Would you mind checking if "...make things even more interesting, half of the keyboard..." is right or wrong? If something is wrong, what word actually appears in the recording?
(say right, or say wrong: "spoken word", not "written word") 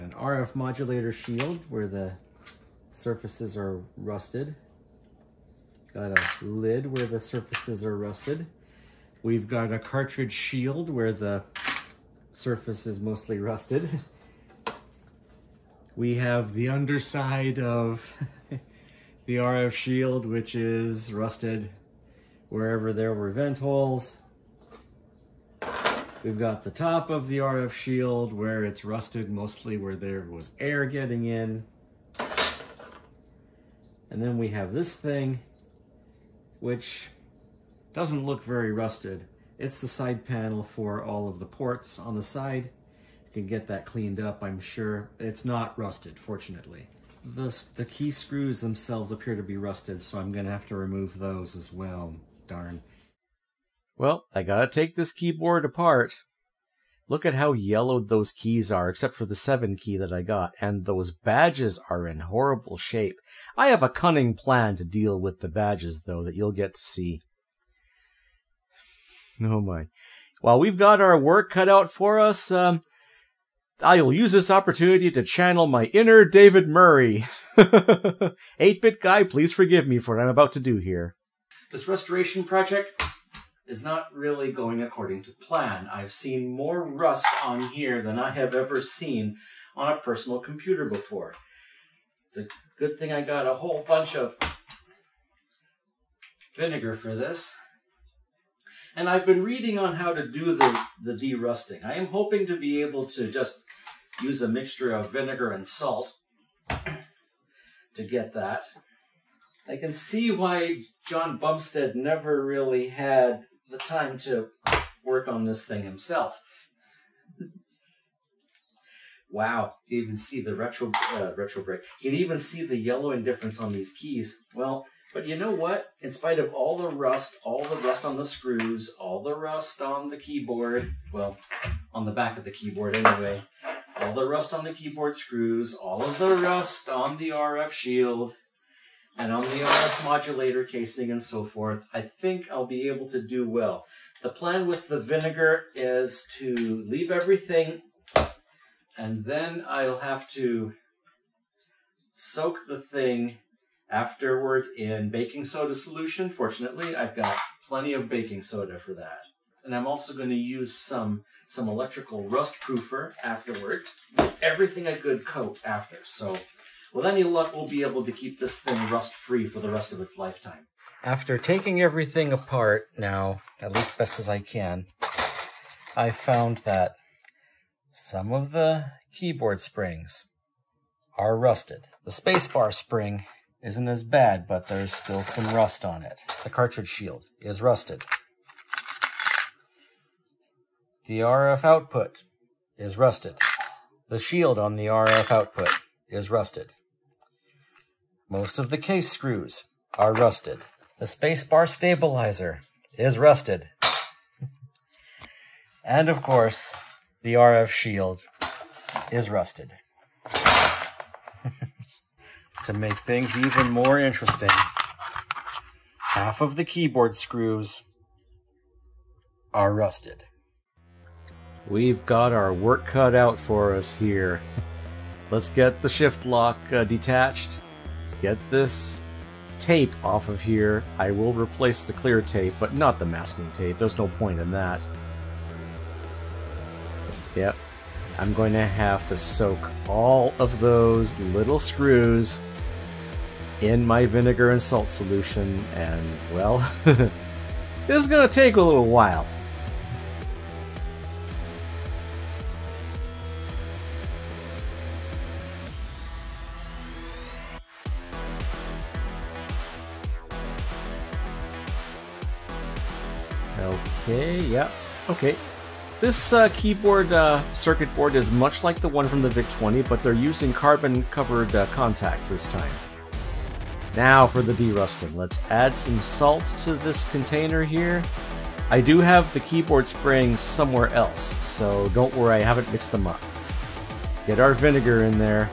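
right.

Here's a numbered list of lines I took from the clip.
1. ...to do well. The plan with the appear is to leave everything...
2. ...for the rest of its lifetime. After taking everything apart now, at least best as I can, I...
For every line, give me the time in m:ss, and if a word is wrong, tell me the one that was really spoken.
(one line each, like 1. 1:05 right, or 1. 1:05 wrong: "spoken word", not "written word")
1. 2:23 wrong: "vinegar", not "appear"
2. 2:49 right.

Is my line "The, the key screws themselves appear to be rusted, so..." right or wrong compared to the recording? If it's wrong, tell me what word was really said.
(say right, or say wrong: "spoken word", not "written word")
right.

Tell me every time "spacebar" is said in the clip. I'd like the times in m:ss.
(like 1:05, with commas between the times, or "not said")
3:02, 3:21.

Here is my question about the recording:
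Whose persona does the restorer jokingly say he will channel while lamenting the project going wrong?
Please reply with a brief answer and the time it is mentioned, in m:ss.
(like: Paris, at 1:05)
David Murray, at 1:16.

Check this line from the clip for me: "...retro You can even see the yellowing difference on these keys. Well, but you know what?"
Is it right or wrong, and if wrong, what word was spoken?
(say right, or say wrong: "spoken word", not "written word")
right.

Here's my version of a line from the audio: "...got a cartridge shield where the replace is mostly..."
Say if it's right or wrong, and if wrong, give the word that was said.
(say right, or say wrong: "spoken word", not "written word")
wrong: "surface", not "replace".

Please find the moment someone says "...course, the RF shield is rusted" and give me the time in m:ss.
3:26.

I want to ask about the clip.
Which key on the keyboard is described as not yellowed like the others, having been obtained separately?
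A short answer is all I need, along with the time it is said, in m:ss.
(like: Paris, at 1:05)
7, at 0:59.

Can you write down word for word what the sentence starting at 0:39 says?
It's the side panel for all of the ports on the side.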